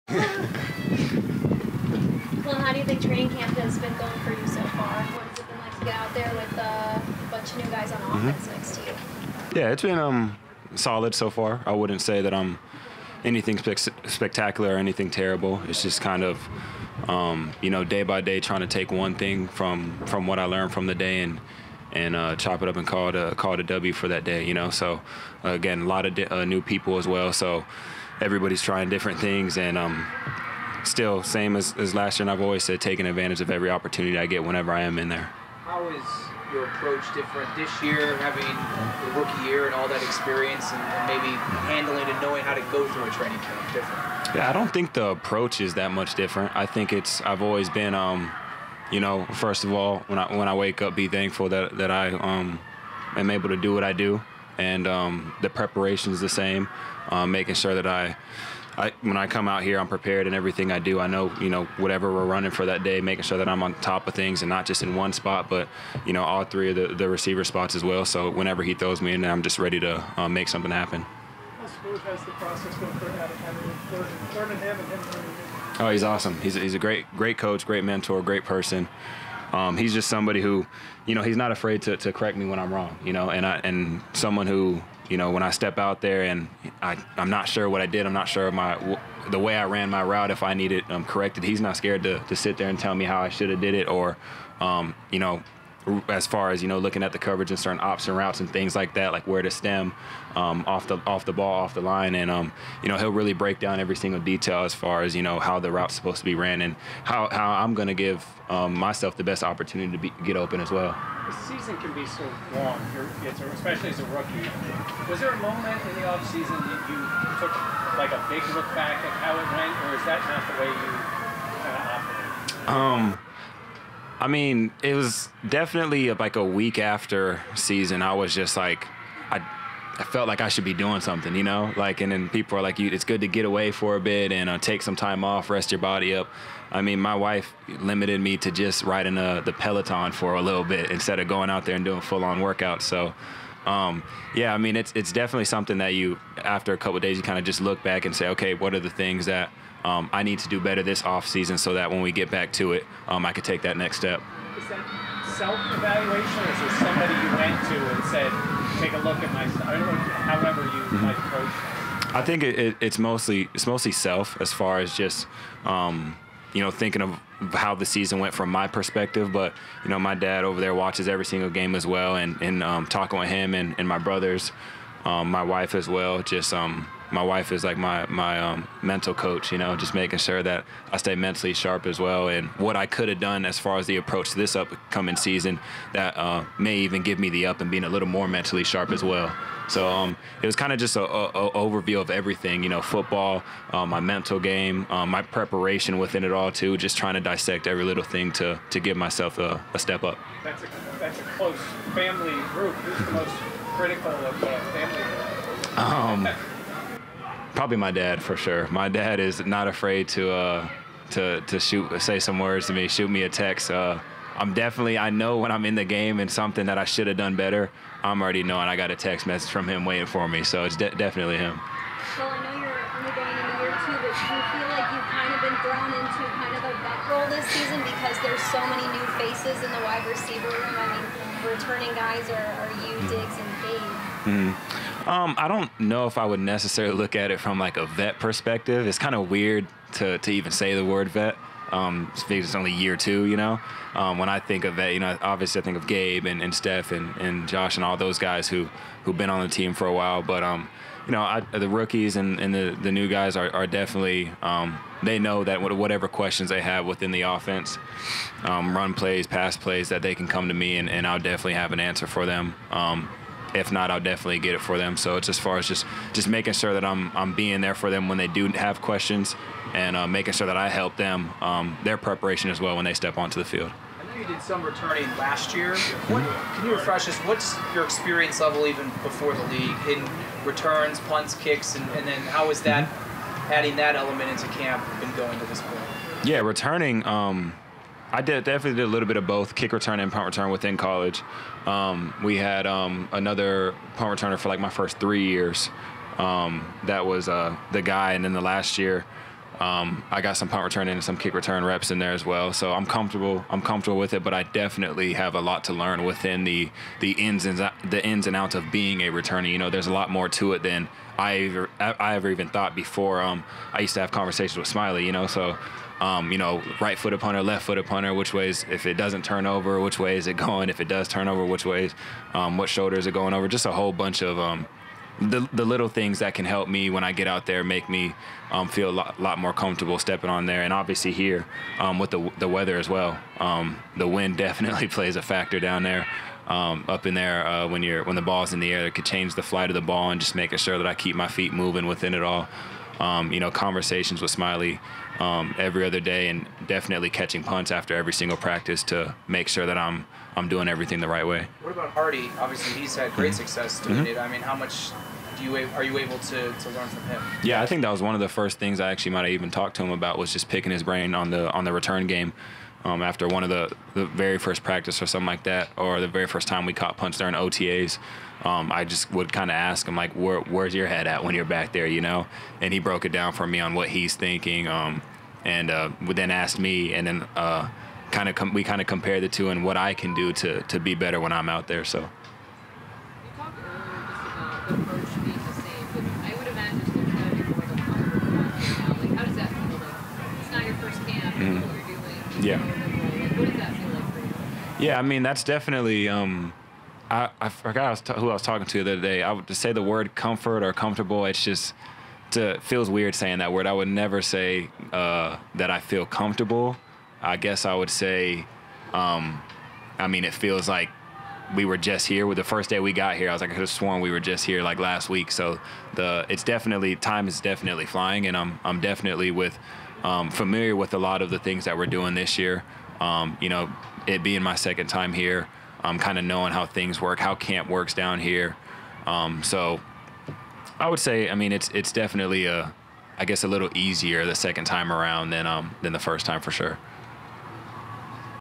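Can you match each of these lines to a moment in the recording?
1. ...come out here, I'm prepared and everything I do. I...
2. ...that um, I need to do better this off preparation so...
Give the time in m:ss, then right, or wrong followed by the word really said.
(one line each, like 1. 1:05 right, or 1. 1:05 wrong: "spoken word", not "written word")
1. 0:59 right
2. 2:29 wrong: "season", not "preparation".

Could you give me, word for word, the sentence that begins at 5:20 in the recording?
If it does turn over, which ways, um, what shoulders are going over?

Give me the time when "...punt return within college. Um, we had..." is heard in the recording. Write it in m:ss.
4:50.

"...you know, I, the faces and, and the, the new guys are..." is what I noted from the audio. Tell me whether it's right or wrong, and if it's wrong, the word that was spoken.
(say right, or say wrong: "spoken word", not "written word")
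wrong: "rookies", not "faces".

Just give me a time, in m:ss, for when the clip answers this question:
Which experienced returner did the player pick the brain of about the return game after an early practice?
5:51.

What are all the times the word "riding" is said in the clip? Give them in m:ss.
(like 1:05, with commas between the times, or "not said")
2:18.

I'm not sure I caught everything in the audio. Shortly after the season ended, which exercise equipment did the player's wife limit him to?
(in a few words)
Peloton.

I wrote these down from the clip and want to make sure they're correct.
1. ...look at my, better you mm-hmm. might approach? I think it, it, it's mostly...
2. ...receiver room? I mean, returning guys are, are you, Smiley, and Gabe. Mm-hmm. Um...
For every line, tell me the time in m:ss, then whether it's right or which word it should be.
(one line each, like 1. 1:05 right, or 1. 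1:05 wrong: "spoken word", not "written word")
1. 2:38 wrong: "however", not "better"
2. 3:50 wrong: "Diggs", not "Smiley".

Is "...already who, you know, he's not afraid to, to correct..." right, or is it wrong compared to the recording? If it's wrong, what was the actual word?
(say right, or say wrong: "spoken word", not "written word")
wrong: "somebody", not "already".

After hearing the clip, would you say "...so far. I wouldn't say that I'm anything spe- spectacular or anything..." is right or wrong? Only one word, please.
right.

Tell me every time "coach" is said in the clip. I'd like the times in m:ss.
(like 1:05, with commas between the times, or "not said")
1:17, 2:59.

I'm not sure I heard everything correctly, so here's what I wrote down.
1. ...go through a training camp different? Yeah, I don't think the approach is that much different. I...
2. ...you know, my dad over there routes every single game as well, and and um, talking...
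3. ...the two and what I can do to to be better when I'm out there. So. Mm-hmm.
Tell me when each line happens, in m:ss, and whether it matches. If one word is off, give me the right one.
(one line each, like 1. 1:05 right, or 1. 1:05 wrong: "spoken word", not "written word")
1. 0:42 right
2. 2:49 wrong: "watches", not "routes"
3. 6:19 right.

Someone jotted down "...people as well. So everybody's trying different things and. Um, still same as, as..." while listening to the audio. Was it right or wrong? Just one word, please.
right.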